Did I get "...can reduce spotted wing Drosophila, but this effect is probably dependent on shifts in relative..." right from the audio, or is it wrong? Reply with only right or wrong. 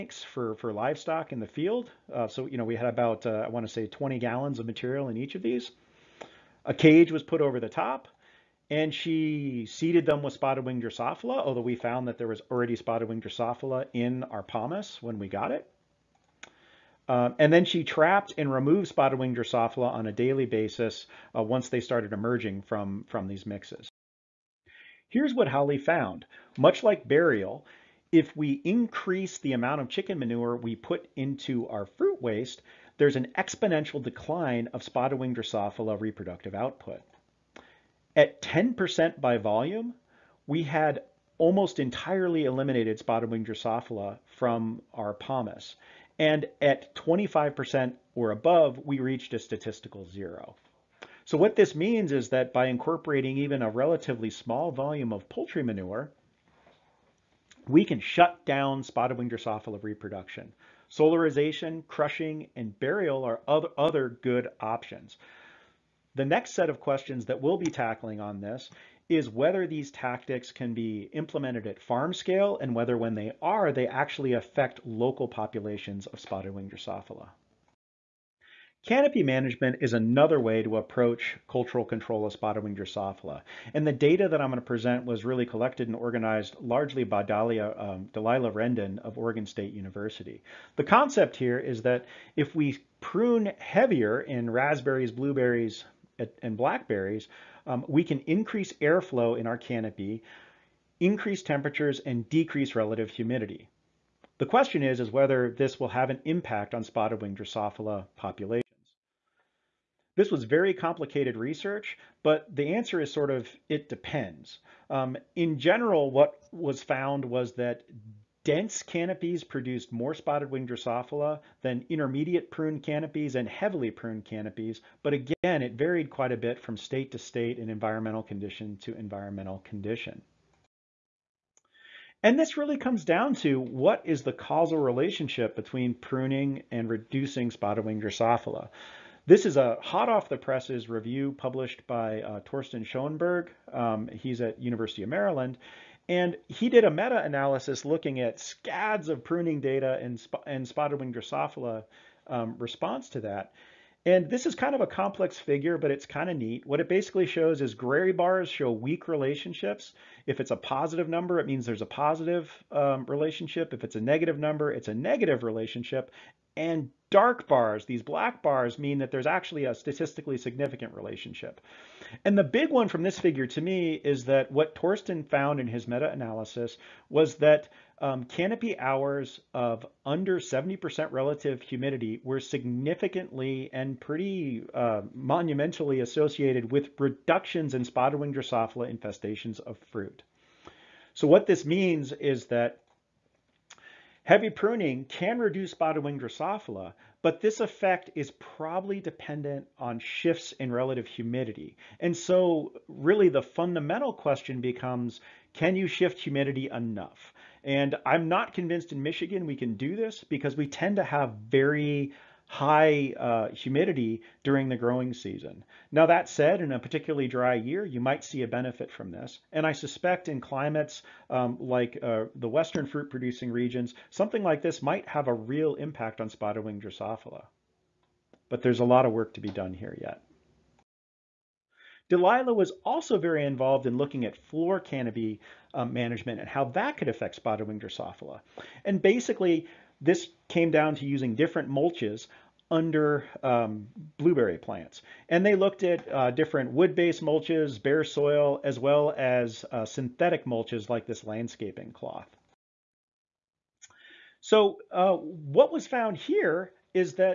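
right.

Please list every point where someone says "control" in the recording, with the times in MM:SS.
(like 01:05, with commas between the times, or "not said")
01:21.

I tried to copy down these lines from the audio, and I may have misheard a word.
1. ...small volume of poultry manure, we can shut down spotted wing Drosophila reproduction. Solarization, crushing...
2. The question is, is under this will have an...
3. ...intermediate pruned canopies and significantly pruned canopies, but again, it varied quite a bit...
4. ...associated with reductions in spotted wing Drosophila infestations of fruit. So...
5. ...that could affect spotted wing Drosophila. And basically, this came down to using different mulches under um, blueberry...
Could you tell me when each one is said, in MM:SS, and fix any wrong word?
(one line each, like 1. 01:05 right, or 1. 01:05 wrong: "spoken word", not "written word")
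1. 00:54 right
2. 01:44 wrong: "whether", not "under"
3. 02:01 wrong: "heavily", not "significantly"
4. 03:05 right
5. 03:56 right.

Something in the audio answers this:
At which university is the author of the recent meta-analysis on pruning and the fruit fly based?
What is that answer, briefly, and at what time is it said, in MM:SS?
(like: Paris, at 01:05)
University of Maryland, at 02:24.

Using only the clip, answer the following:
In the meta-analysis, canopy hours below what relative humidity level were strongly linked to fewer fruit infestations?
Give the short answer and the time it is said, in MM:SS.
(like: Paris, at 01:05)
70%, at 03:00.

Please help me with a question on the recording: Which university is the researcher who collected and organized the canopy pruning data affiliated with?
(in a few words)
Oregon State University.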